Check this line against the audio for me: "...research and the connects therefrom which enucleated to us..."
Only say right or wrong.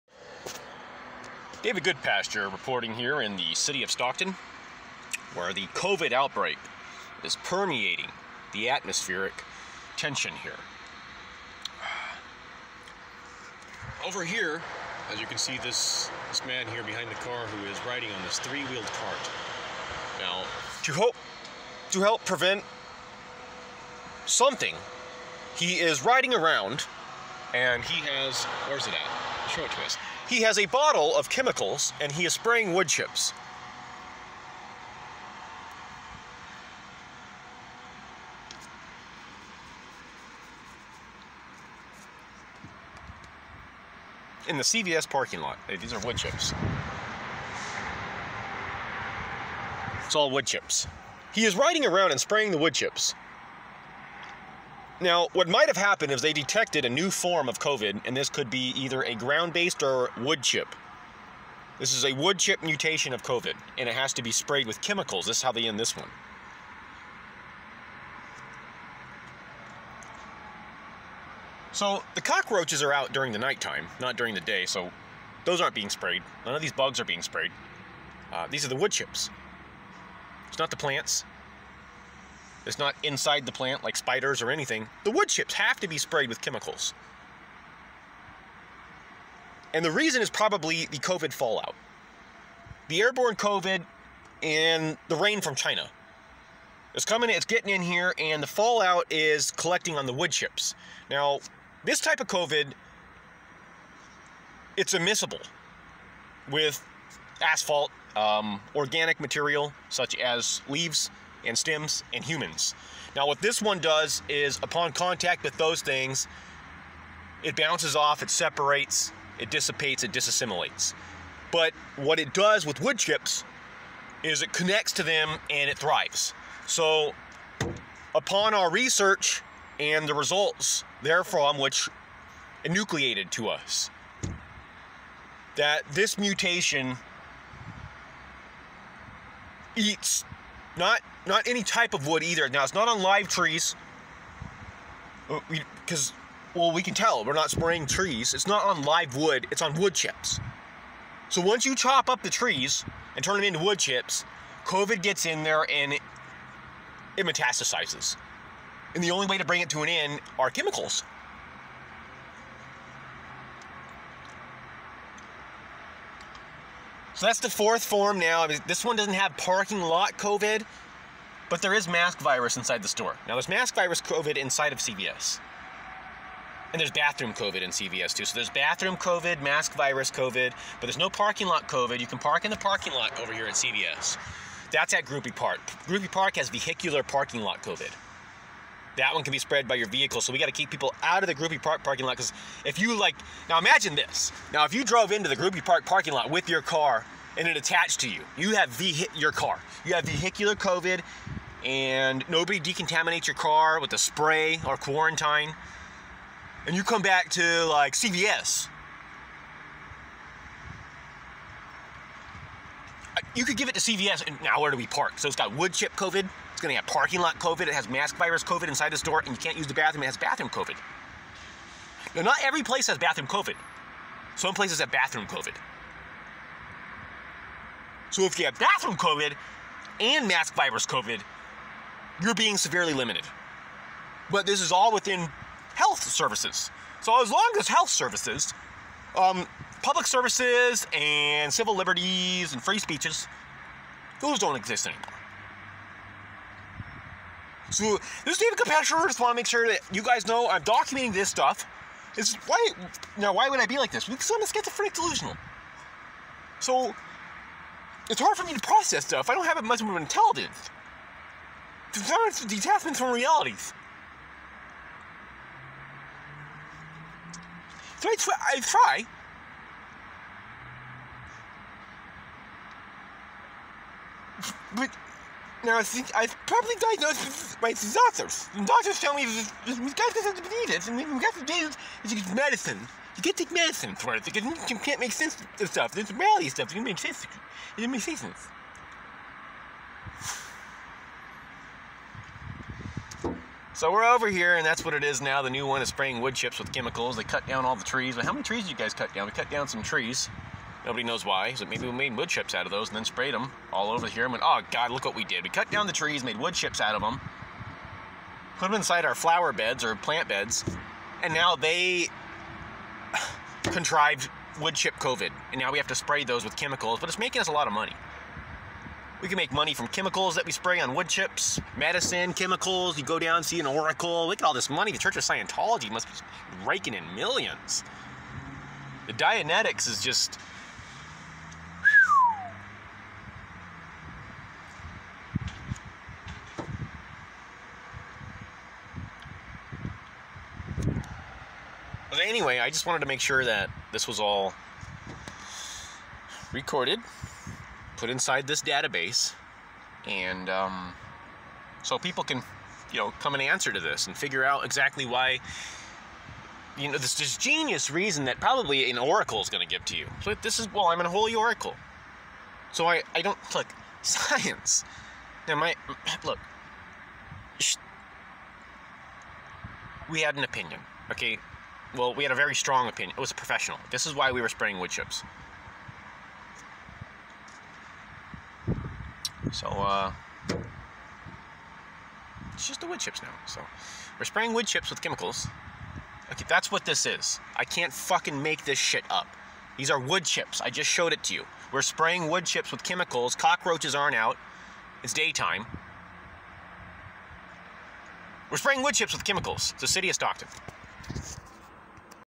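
wrong.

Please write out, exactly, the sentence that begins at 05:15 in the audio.
And now we have to spray those with chemicals, but it's making us a lot of money.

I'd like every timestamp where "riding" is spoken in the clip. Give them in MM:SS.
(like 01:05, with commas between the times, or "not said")
00:17, 00:26, 00:51.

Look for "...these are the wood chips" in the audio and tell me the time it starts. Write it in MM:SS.
01:18.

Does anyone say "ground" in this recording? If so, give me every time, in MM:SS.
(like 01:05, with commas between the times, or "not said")
00:59.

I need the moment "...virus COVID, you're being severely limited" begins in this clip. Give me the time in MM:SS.
03:50.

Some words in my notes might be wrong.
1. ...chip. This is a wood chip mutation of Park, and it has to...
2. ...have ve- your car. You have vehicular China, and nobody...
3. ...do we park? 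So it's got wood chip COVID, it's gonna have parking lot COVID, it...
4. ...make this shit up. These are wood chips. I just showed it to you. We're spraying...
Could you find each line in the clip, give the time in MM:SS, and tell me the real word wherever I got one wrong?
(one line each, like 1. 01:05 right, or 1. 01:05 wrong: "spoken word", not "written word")
1. 01:00 wrong: "COVID", not "Park"
2. 03:18 wrong: "COVID", not "China"
3. 03:34 right
4. 06:28 right.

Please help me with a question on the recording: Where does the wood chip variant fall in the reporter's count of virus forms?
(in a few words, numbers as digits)
fourth.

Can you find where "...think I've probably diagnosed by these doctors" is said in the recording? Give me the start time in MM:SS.
04:35.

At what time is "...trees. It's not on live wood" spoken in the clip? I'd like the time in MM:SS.
02:27.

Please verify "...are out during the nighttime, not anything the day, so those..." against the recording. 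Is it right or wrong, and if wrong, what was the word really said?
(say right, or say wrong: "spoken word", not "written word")
wrong: "during", not "anything".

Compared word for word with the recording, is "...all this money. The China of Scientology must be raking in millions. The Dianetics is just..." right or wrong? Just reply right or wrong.
wrong.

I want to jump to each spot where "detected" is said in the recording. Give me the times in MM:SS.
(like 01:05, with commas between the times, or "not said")
00:56.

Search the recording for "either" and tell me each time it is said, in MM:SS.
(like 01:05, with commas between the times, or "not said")
00:58, 02:22.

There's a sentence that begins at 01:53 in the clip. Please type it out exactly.
Now what this one does is upon contact with those things, it bounces off, it separates, it dissipates, it disassimilates.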